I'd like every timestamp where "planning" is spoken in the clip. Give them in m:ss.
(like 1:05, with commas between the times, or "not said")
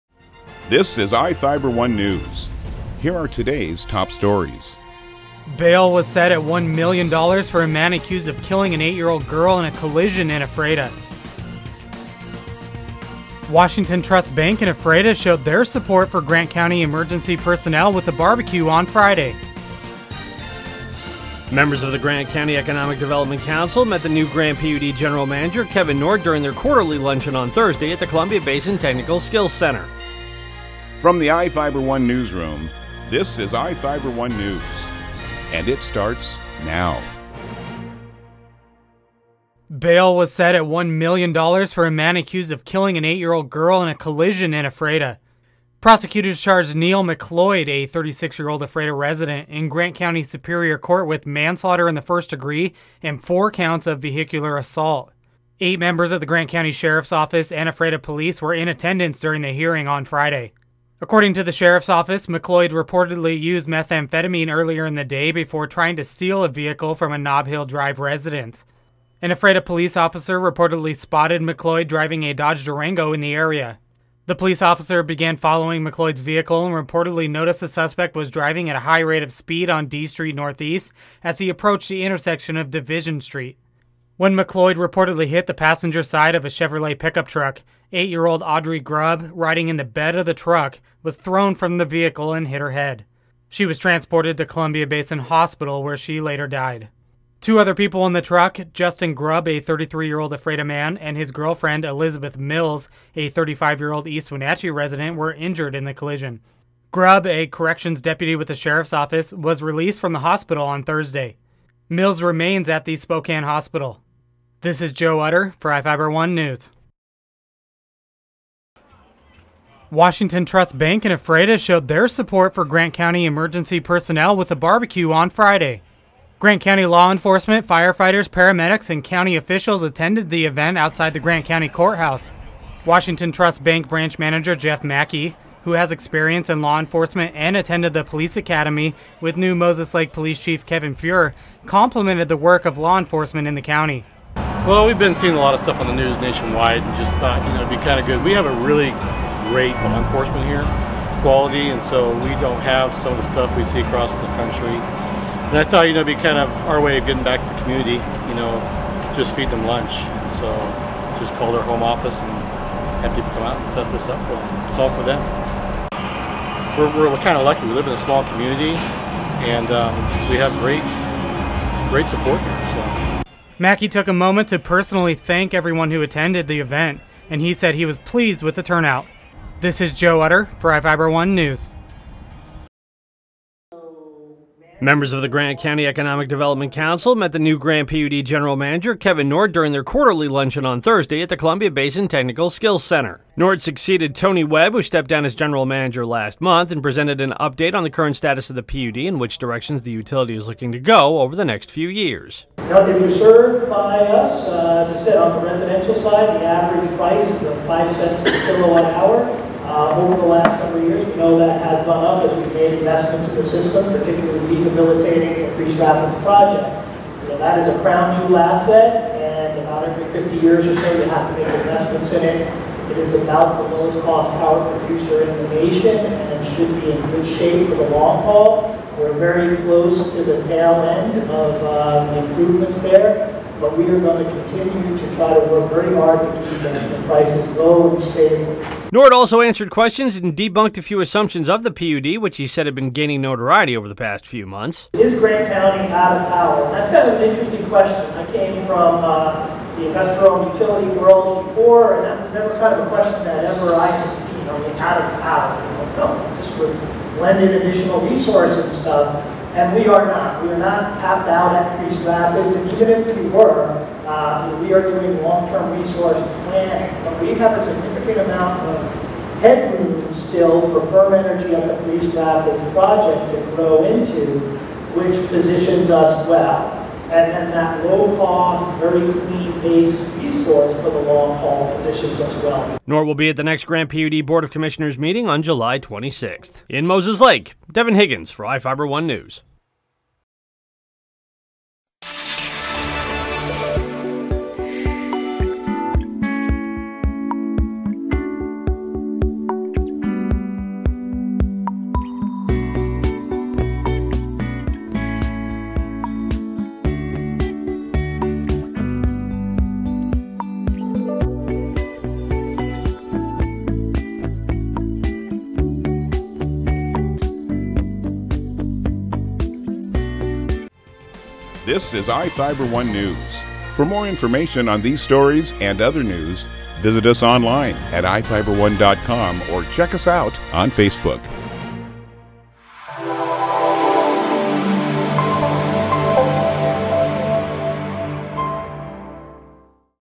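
4:26.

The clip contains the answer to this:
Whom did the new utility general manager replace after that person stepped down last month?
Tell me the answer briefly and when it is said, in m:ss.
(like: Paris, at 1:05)
Tony Webb, at 3:14.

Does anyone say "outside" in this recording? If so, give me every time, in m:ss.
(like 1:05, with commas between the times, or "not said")
2:10.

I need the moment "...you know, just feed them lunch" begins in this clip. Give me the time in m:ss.
2:38.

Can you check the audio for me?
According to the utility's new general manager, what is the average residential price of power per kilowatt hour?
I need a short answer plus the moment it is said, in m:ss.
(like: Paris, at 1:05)
5 cents, at 3:27.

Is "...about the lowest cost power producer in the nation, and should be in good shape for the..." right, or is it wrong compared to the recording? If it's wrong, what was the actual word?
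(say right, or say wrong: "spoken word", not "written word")
right.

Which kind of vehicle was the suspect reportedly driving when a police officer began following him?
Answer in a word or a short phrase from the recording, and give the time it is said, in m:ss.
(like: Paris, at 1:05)
Dodge Durango, at 1:12.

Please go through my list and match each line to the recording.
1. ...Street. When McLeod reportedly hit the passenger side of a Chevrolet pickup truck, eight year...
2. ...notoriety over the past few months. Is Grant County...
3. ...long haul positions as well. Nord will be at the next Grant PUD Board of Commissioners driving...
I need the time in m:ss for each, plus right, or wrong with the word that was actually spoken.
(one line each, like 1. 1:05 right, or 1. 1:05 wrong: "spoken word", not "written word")
1. 1:23 right
2. 4:03 right
3. 4:41 wrong: "meeting", not "driving".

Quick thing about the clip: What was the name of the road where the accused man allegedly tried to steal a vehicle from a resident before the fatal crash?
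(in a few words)
Nob Hill Drive.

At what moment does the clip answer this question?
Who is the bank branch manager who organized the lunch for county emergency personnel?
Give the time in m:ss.
2:14.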